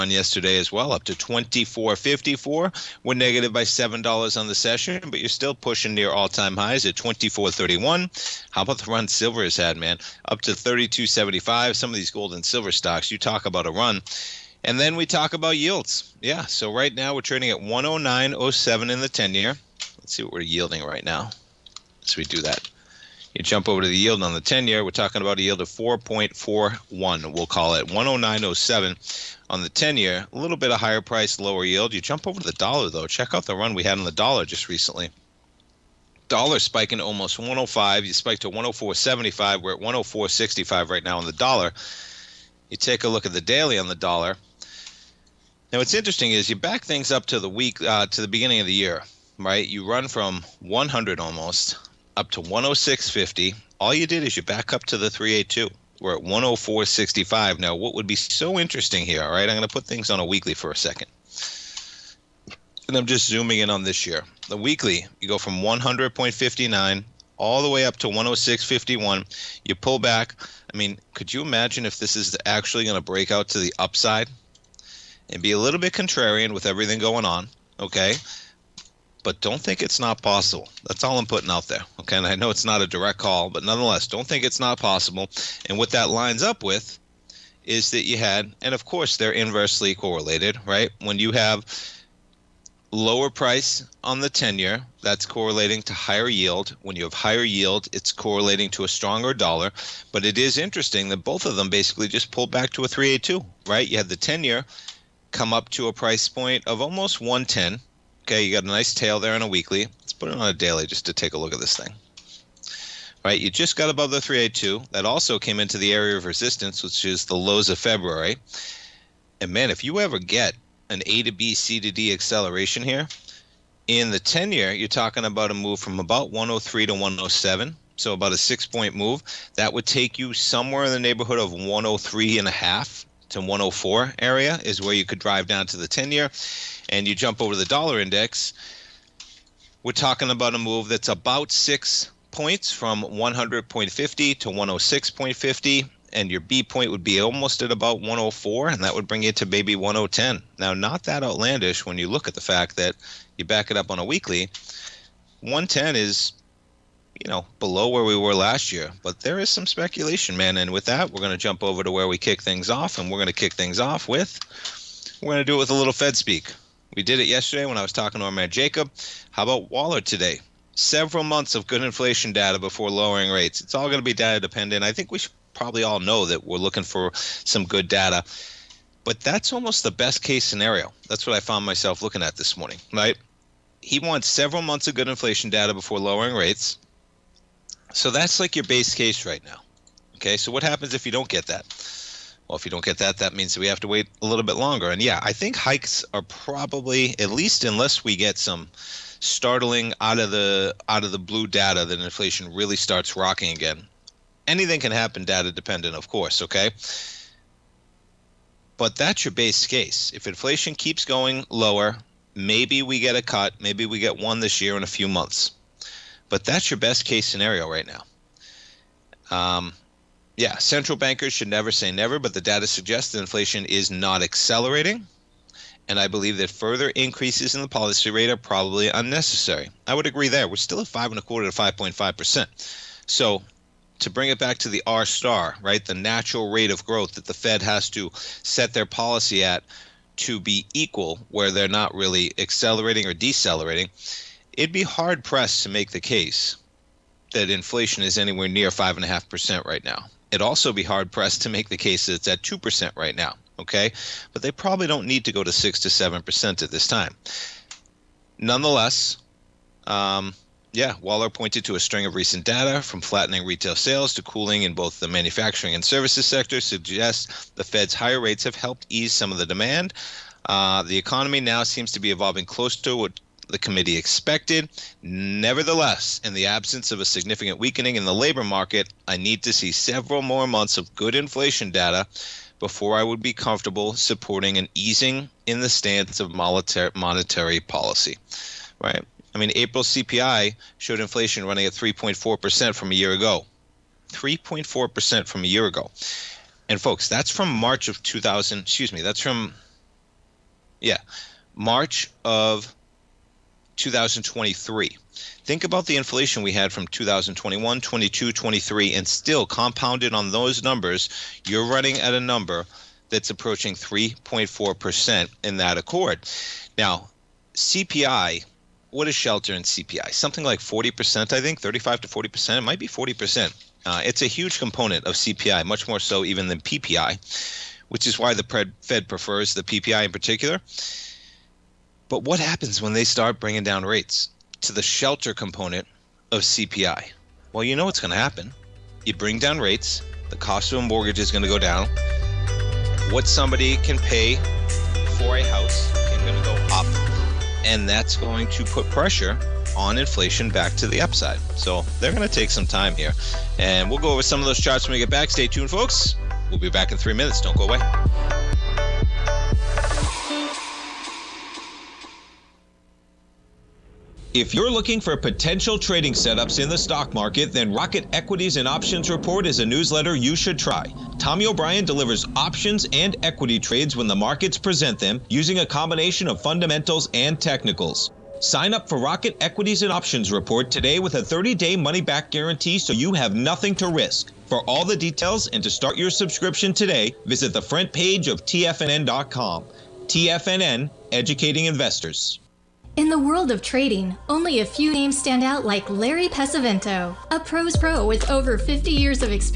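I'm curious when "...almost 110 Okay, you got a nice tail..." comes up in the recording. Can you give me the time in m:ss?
1:46.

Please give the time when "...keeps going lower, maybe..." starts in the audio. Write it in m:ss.
3:30.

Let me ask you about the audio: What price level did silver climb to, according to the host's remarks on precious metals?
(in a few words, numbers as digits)
32.75.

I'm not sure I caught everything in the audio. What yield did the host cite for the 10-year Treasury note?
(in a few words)
4.41.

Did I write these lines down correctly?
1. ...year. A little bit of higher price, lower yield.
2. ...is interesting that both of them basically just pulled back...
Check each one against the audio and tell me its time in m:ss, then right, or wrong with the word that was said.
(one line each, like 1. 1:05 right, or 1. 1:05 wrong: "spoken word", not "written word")
1. 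0:29 right
2. 1:40 right.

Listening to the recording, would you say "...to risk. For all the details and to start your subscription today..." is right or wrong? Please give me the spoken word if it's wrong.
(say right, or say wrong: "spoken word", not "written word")
right.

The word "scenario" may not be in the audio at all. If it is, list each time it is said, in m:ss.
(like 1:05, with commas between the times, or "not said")
3:00, 3:37.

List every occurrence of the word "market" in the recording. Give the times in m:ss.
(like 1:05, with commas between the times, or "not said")
4:38, 6:07, 6:14.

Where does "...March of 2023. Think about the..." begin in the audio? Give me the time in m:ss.
5:01.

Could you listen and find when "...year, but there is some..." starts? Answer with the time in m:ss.
2:38.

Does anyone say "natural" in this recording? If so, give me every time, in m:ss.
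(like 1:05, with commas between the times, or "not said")
3:55.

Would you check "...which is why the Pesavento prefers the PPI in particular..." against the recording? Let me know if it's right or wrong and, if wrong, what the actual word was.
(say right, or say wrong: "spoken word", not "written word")
wrong: "Fed", not "Pesavento".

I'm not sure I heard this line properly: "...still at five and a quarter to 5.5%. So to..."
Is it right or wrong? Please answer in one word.
right.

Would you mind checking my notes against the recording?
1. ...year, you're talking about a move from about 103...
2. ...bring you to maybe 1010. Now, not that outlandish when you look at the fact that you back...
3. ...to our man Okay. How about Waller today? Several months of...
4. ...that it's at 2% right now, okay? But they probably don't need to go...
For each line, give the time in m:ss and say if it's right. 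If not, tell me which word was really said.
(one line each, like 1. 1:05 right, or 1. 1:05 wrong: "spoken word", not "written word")
1. 2:04 right
2. 2:29 right
3. 2:48 wrong: "Jacob", not "Okay"
4. 4:12 right.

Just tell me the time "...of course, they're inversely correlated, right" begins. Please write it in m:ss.
1:28.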